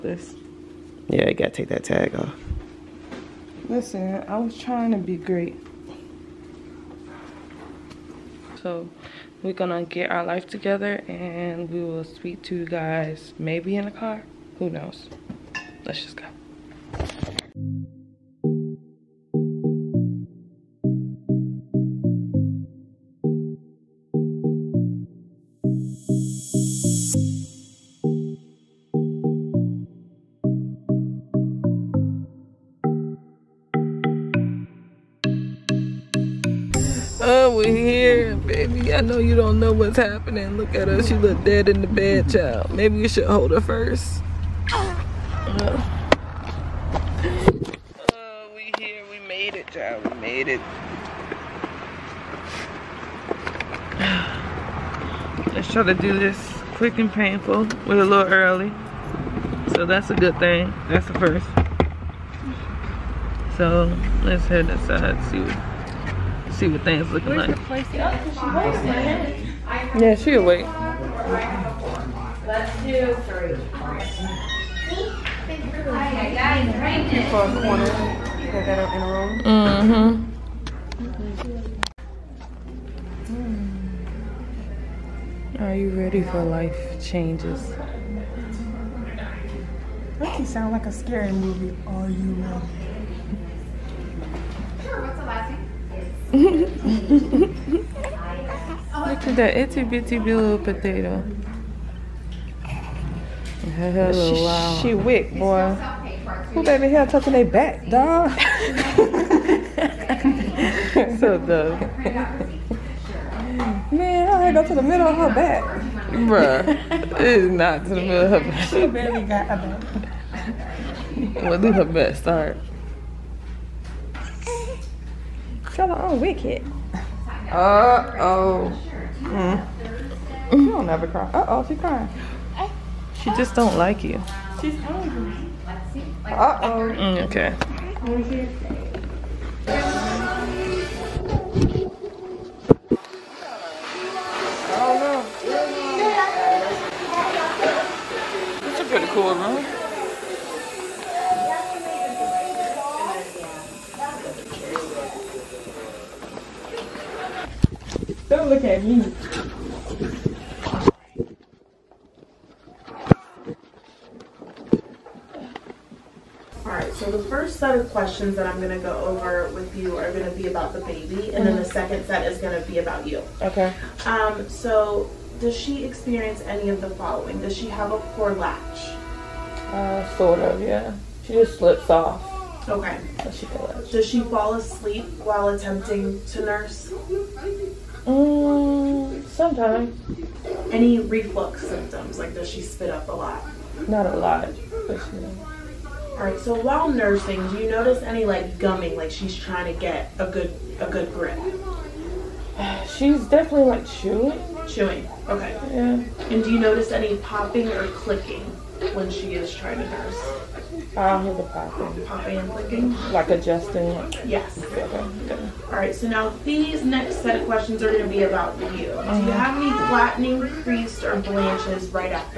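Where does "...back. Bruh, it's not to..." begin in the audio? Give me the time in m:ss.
1:55.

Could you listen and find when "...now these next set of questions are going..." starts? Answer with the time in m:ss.
3:36.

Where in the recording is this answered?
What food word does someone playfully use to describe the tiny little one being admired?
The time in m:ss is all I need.
1:40.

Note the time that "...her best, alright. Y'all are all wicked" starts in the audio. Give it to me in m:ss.
2:01.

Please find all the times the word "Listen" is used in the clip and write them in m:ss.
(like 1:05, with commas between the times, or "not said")
0:03.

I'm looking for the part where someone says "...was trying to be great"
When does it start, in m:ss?
0:04.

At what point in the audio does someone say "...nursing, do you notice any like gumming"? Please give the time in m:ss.
3:16.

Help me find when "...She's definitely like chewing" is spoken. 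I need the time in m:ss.
3:22.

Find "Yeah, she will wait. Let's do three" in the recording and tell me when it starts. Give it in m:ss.
1:09.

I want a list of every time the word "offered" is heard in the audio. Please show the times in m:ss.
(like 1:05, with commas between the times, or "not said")
not said.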